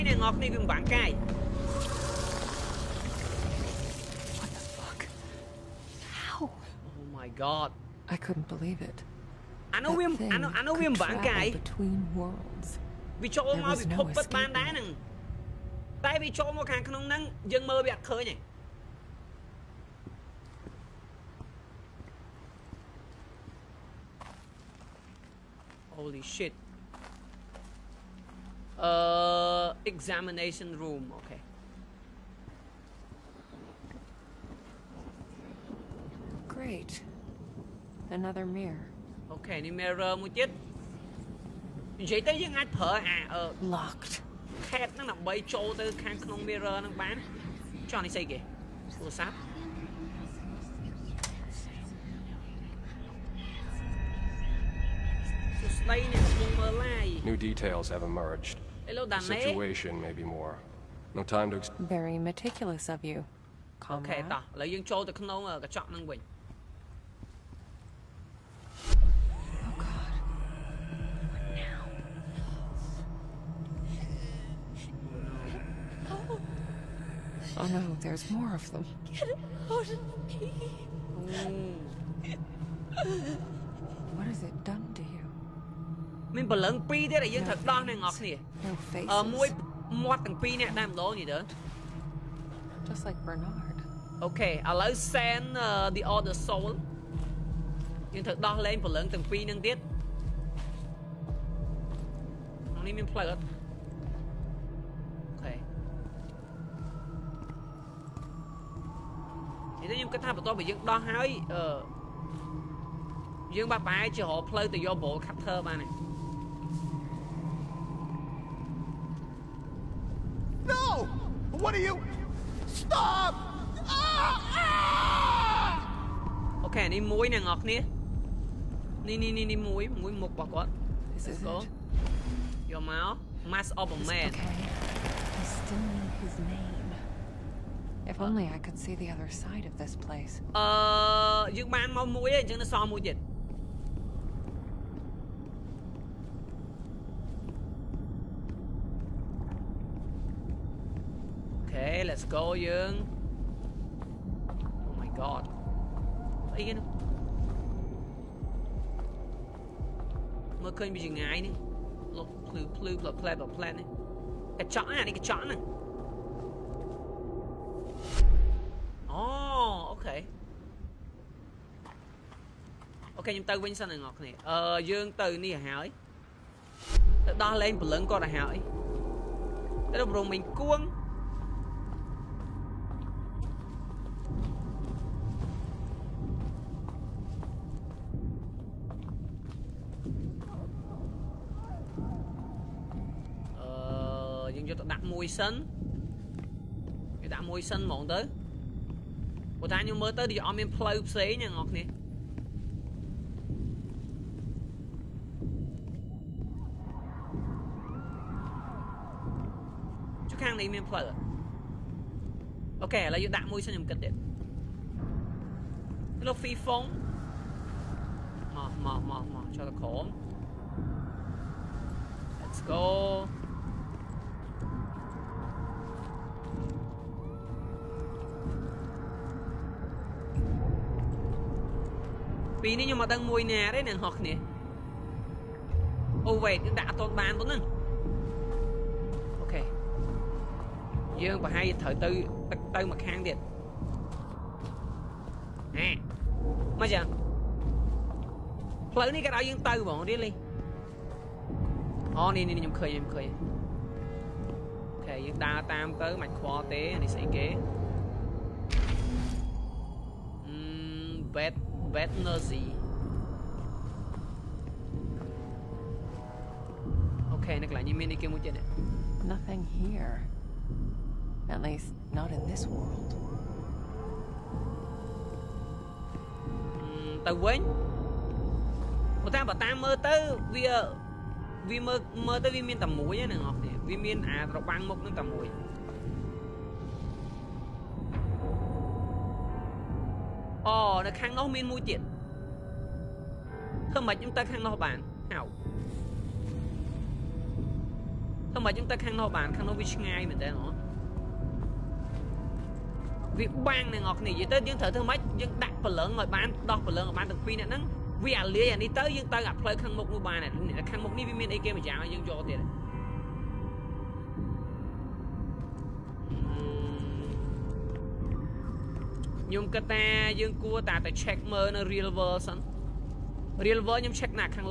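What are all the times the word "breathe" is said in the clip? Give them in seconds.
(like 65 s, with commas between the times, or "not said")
not said.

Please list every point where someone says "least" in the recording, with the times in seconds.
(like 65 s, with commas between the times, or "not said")
271 s.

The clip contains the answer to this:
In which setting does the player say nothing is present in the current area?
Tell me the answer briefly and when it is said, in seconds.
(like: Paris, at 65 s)
This world, at 272 s.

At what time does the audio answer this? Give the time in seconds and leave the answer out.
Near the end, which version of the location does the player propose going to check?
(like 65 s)
321 s.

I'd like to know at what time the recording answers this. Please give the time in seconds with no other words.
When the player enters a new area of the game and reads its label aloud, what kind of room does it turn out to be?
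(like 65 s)
29 s.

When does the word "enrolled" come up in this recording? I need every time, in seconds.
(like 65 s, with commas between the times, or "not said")
not said.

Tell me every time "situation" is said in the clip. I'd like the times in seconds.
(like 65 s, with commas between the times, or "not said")
59 s.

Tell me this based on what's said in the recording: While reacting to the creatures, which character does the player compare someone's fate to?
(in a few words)
Bernard.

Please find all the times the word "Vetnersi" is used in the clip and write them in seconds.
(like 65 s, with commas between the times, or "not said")
261 s.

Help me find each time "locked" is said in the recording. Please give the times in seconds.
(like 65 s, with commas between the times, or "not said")
43 s.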